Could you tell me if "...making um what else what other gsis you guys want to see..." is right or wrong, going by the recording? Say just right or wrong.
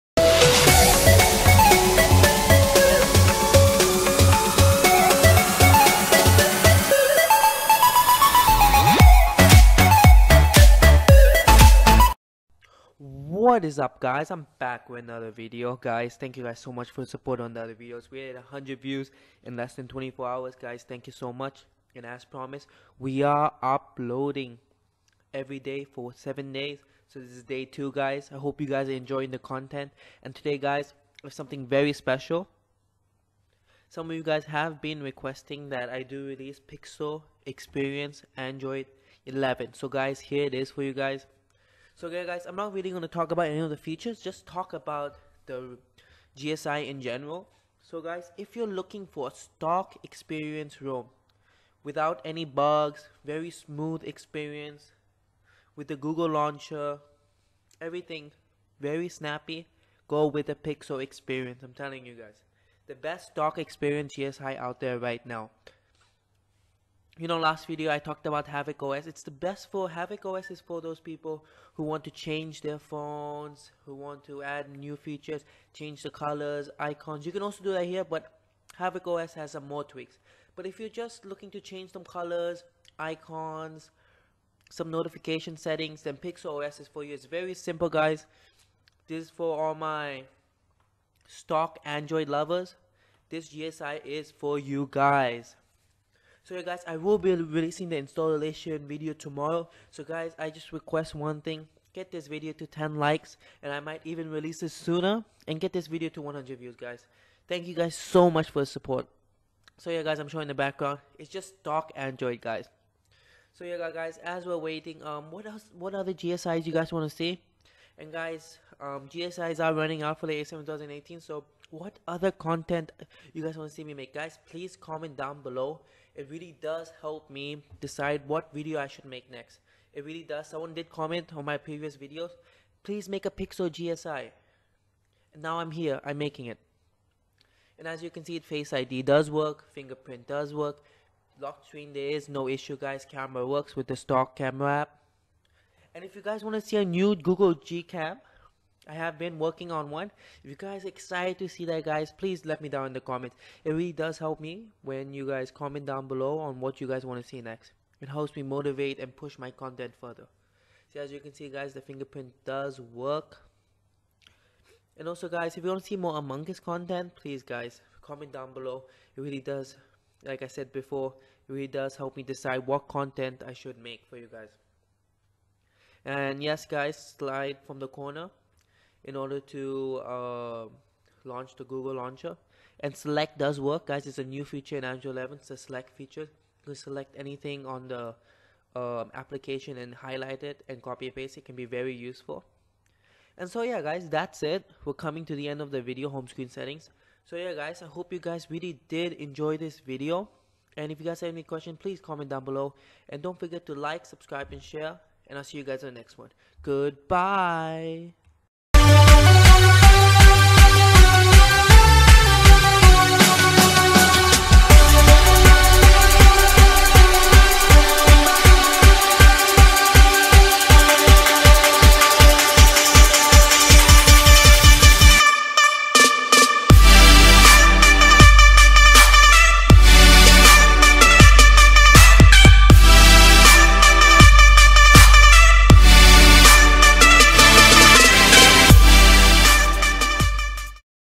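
wrong.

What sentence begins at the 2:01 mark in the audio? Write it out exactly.
So what other content you guys want to see me make?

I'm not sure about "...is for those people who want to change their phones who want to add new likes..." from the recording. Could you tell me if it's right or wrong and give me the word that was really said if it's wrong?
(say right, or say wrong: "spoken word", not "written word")
wrong: "features", not "likes".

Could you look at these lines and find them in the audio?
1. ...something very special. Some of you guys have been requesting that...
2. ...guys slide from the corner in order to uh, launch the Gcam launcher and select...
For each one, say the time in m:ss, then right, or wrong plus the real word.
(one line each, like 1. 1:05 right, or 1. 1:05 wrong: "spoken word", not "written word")
1. 0:31 right
2. 2:56 wrong: "Google", not "Gcam".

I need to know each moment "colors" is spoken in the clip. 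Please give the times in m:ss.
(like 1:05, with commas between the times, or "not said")
1:16, 1:22.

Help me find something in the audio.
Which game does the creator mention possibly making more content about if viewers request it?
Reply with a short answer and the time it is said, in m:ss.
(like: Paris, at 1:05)
Among Us, at 2:46.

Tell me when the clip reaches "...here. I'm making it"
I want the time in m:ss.
2:15.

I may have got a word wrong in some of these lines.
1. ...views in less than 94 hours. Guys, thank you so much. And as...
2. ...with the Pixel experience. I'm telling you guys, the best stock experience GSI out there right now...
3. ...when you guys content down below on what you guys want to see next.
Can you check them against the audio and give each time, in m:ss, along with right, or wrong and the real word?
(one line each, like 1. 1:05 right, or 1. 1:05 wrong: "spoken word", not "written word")
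1. 0:18 wrong: "24", not "94"
2. 1:00 right
3. 2:34 wrong: "comment", not "content".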